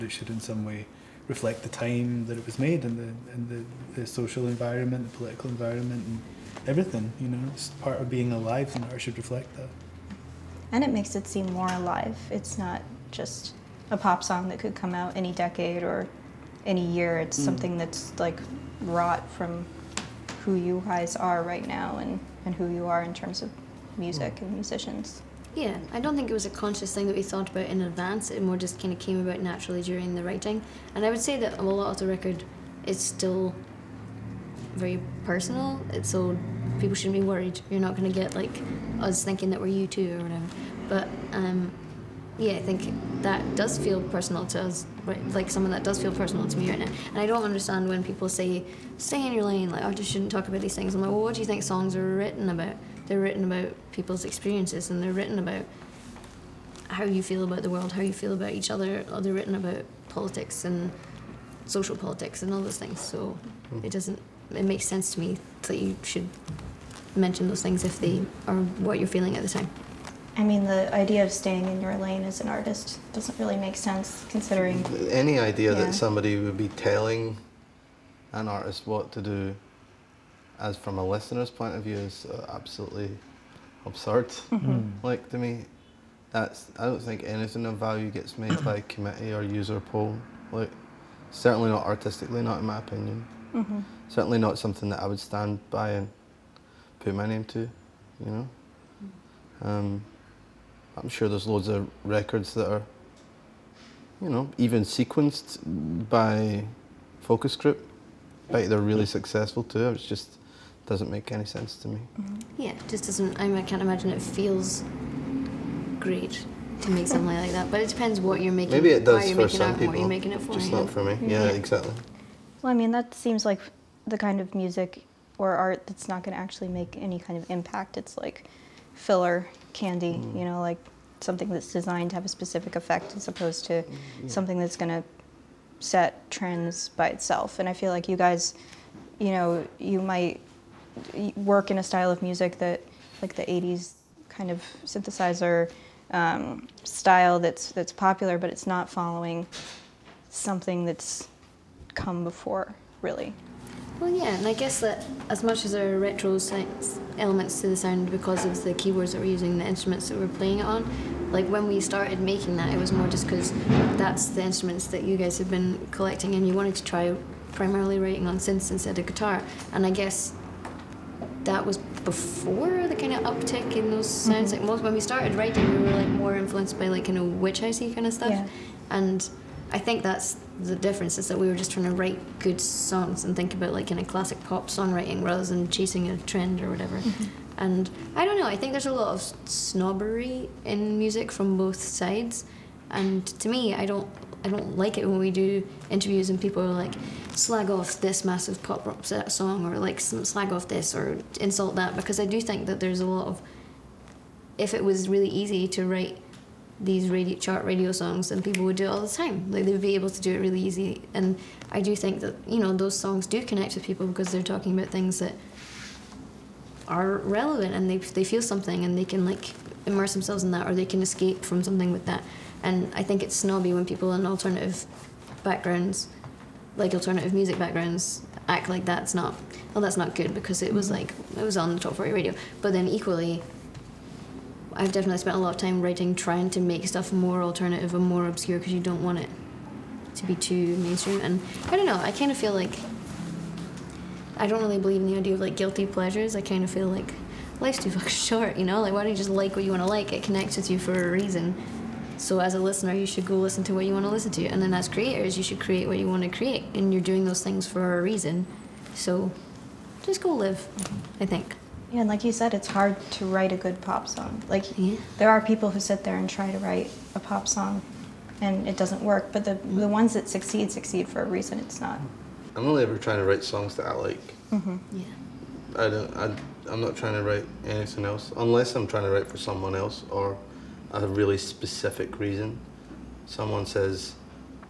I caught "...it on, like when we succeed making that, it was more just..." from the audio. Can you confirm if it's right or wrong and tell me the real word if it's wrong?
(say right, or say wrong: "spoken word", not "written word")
wrong: "started", not "succeed".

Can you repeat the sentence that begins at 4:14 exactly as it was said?
And then as creators, you should create what you want to create.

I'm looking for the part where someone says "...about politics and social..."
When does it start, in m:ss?
0:59.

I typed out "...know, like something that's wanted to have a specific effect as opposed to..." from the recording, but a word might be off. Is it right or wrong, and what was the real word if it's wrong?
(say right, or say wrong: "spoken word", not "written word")
wrong: "designed", not "wanted".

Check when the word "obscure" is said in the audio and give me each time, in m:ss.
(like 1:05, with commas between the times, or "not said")
3:58.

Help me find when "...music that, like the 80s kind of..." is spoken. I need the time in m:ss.
2:22.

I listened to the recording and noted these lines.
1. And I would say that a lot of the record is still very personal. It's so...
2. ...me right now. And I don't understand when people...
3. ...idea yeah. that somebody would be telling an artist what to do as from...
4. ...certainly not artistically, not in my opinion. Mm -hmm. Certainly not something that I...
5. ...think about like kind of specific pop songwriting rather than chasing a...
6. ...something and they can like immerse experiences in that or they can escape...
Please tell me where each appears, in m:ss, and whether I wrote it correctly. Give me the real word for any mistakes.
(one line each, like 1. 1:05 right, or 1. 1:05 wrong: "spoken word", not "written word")
1. 0:30 right
2. 0:46 right
3. 1:15 right
4. 1:31 right
5. 3:03 wrong: "classic", not "specific"
6. 3:38 wrong: "themselves", not "experiences".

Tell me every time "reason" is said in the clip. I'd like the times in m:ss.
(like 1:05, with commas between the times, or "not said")
4:11, 4:18, 4:31, 4:42.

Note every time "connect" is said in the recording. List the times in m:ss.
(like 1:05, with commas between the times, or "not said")
3:33, 4:10.